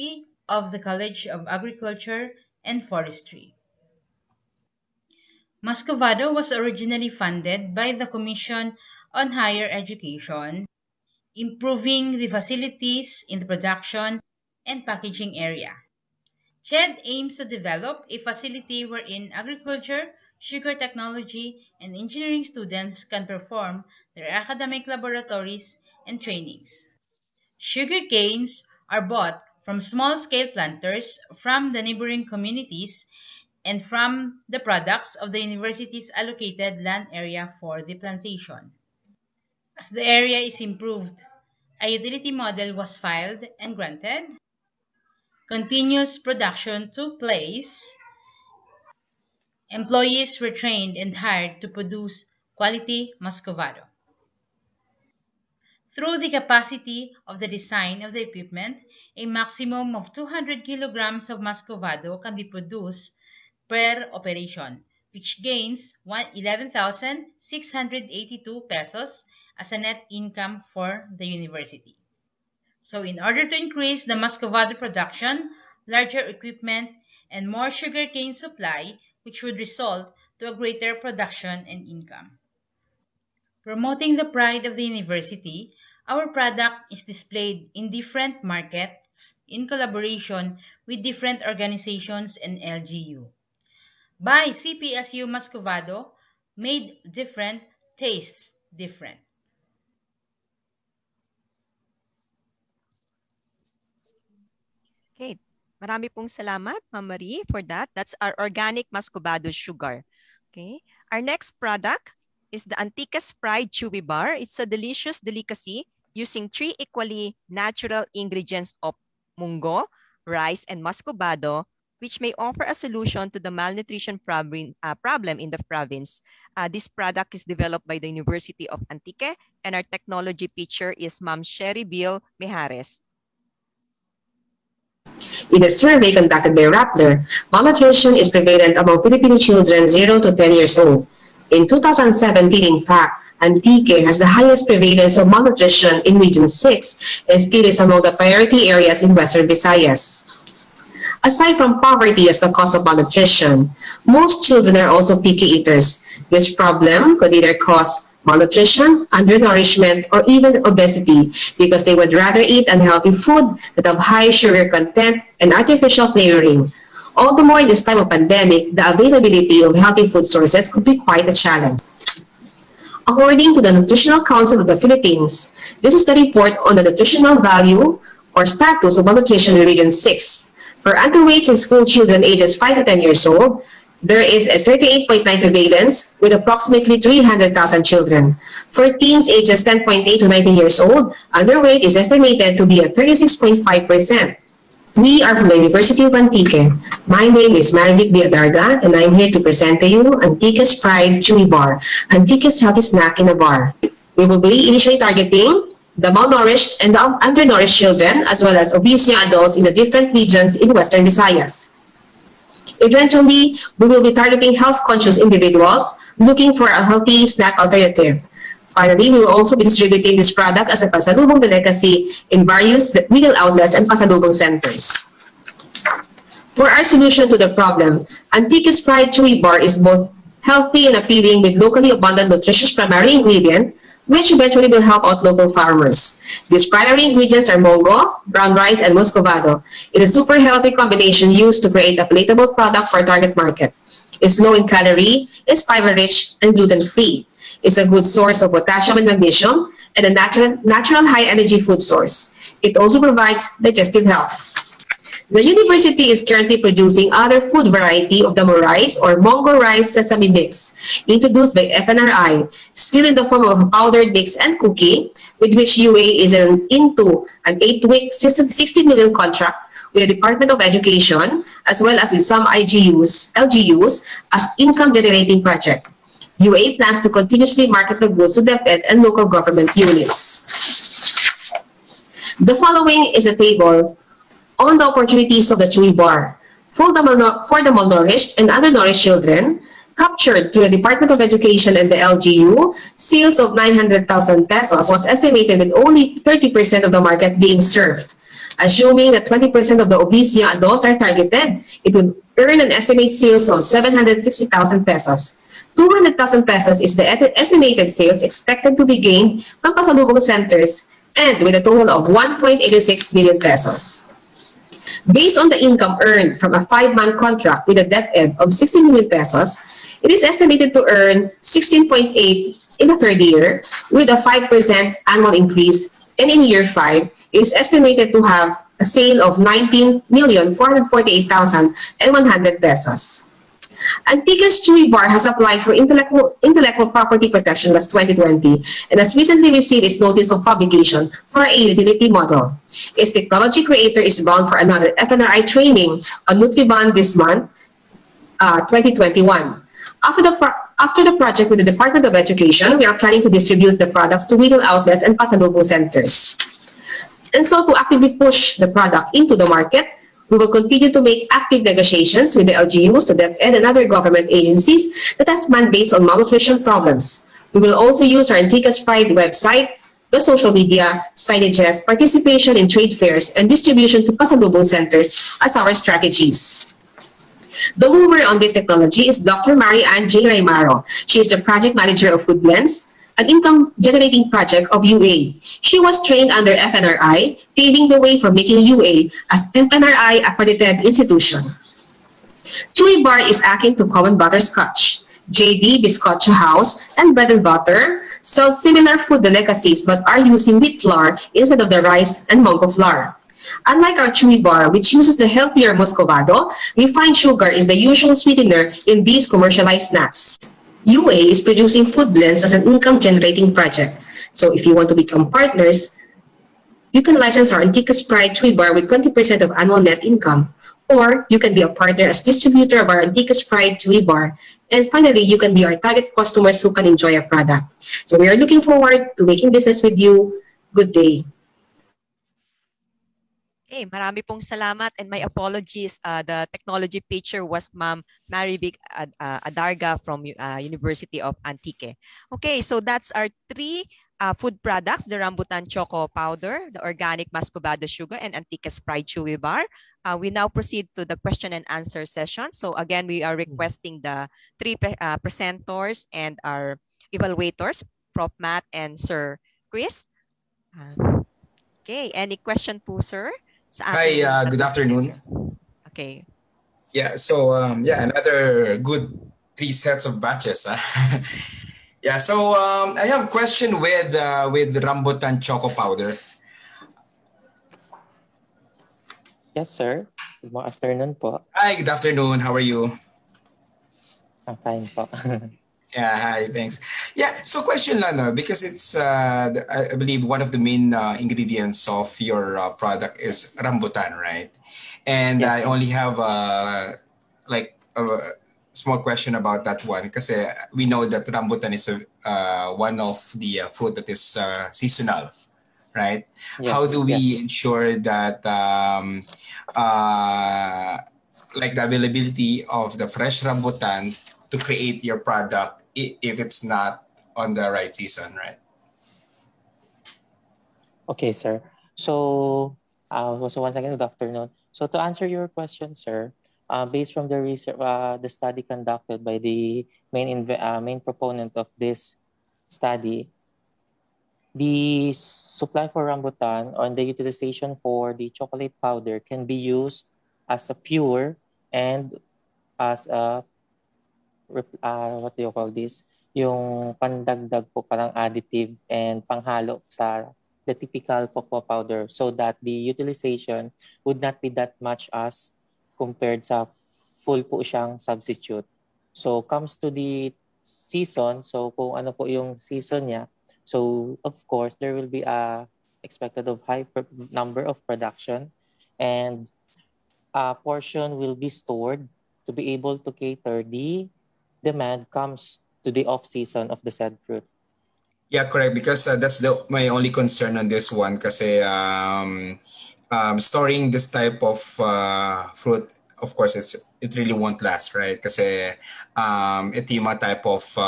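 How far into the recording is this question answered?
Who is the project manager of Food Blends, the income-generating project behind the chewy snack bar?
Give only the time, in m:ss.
6:19.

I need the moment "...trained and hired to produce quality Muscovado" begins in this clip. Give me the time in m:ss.
0:50.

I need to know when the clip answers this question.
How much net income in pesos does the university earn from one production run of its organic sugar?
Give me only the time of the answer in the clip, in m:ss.
1:06.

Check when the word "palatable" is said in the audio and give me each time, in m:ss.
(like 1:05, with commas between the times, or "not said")
4:02.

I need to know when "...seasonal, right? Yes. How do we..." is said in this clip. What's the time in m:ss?
8:24.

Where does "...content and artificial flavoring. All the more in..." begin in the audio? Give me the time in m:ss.
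2:44.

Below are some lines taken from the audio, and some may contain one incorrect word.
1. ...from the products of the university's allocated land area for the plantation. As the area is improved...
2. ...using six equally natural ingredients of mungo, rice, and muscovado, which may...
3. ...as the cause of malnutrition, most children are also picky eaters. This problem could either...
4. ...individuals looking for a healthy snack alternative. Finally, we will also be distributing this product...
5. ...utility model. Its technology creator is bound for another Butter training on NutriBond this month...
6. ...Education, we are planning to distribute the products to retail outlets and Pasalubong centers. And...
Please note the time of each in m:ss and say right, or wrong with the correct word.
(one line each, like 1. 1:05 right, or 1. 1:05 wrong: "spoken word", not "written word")
1. 0:33 right
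2. 1:56 wrong: "three", not "six"
3. 2:32 right
4. 3:35 right
5. 5:41 wrong: "FNRI", not "Butter"
6. 5:52 right.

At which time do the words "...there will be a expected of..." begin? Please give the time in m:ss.
9:24.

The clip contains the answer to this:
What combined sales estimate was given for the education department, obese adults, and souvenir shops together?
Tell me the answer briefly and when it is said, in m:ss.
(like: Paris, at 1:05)
1.86 million pesos, at 5:12.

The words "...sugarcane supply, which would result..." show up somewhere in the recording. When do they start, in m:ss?
1:17.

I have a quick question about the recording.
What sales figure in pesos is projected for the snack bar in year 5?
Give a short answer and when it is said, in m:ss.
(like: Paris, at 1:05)
19,448,100 pesos, at 5:29.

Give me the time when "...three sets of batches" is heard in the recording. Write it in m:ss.
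7:49.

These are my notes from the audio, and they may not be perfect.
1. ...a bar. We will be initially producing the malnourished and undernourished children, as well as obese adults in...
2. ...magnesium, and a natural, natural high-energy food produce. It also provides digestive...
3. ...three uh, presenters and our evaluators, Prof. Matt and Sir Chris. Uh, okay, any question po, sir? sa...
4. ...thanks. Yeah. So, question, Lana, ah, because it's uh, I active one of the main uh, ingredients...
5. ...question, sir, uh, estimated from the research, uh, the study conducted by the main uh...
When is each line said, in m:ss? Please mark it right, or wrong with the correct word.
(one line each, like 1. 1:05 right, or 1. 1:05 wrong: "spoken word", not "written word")
1. 3:23 wrong: "targeting", not "producing"
2. 4:09 wrong: "source", not "produce"
3. 7:34 right
4. 8:06 wrong: "believe", not "active"
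5. 8:45 wrong: "based", not "estimated".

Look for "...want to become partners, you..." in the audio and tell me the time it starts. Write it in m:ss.
6:54.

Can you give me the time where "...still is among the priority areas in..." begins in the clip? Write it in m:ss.
2:27.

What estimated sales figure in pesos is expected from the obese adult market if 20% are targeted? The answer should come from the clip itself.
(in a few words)
760,000 pesos.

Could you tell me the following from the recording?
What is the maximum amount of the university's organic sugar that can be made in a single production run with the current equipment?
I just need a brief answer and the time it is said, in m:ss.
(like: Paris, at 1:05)
200 kilograms, at 1:00.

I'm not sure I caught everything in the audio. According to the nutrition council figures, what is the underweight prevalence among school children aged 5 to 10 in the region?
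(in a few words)
38.9.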